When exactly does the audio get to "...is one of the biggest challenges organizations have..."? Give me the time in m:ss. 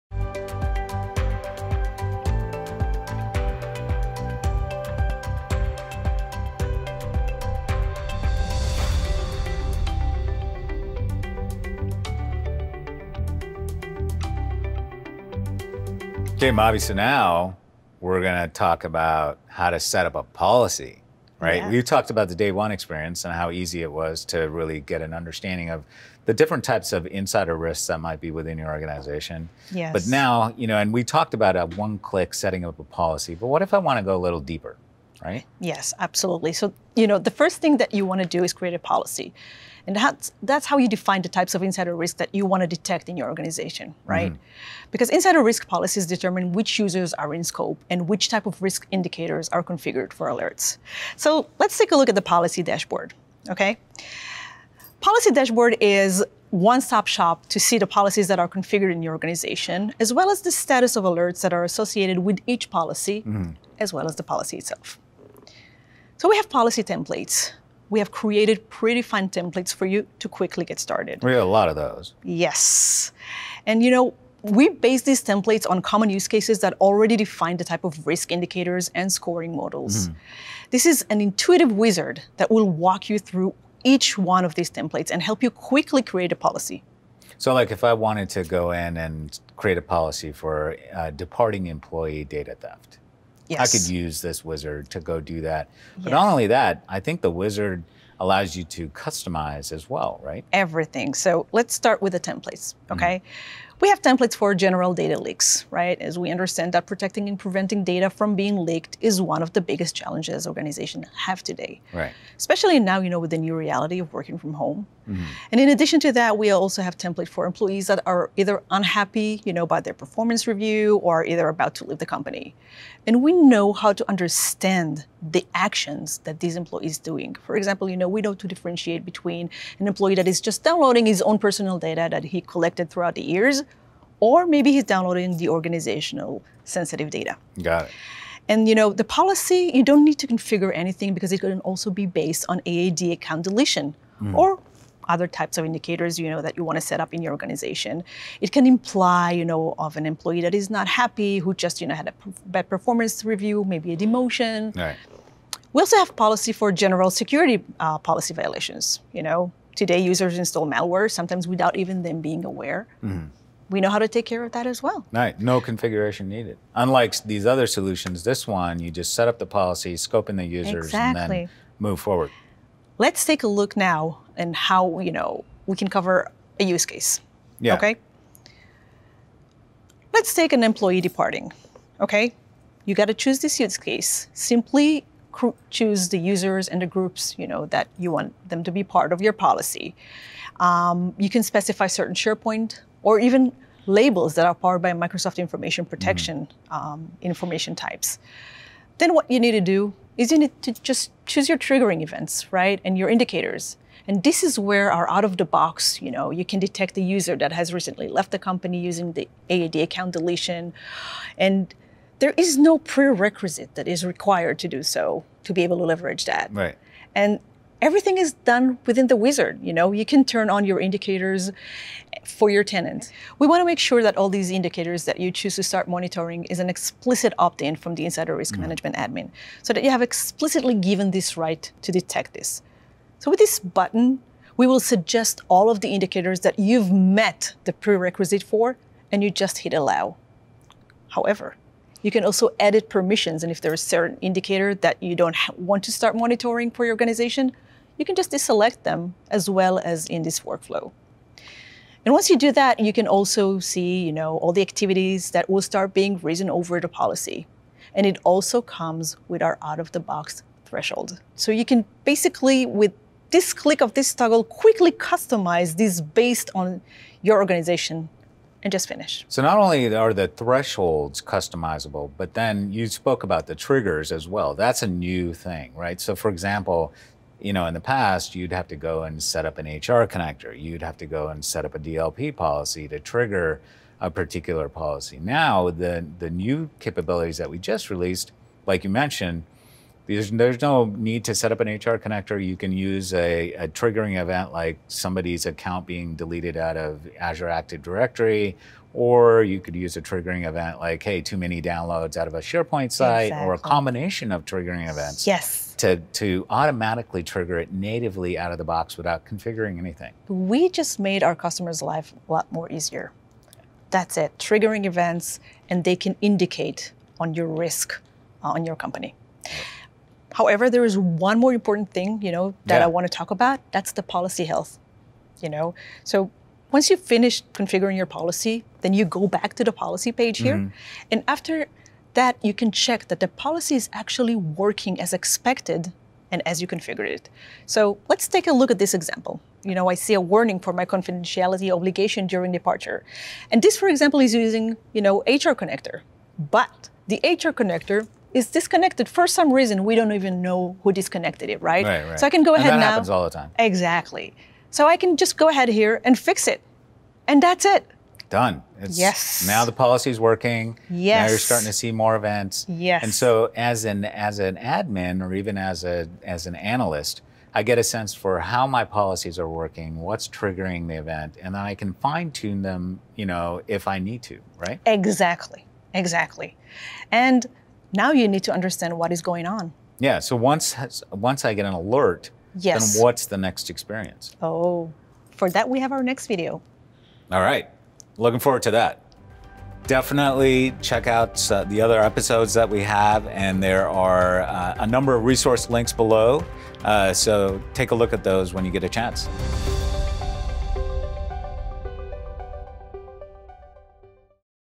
1:49.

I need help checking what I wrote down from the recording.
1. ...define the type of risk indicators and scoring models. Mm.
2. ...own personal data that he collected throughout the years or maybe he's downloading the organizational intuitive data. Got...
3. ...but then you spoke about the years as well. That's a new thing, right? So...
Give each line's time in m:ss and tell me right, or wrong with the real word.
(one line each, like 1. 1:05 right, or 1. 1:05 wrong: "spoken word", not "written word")
1. 1:17 right
2. 2:11 wrong: "sensitive", not "intuitive"
3. 4:32 wrong: "triggers", not "years".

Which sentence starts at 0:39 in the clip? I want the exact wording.
And that's, that's how you define the types of insider risk that you want to detect in your organization, right?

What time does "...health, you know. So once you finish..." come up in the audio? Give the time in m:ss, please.
5:24.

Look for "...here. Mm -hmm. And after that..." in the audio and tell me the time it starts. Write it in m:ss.
5:30.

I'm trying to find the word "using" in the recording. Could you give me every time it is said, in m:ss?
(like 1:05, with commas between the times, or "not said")
3:28, 5:44.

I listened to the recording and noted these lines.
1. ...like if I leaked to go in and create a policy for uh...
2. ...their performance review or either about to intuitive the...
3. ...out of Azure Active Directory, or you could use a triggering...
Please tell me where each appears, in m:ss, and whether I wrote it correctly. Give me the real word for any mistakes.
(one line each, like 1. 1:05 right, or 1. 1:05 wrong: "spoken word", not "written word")
1. 1:27 wrong: "wanted", not "leaked"
2. 1:59 wrong: "leave", not "intuitive"
3. 4:56 right.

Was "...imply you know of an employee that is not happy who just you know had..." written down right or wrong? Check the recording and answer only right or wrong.
right.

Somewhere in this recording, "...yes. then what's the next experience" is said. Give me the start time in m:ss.
6:22.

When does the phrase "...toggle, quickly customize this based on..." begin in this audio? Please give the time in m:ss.
4:24.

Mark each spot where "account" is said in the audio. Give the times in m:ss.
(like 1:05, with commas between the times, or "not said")
2:23, 3:29, 4:55.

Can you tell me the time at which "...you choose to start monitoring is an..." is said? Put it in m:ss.
3:45.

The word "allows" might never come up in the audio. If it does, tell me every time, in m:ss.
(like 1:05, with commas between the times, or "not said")
1:38, 3:59.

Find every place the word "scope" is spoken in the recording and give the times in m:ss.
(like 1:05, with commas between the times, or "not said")
0:47, 2:49.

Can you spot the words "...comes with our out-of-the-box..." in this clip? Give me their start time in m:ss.
4:18.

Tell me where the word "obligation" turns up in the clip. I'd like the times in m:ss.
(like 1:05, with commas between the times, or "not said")
5:41.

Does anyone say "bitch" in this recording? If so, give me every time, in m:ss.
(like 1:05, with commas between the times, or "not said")
not said.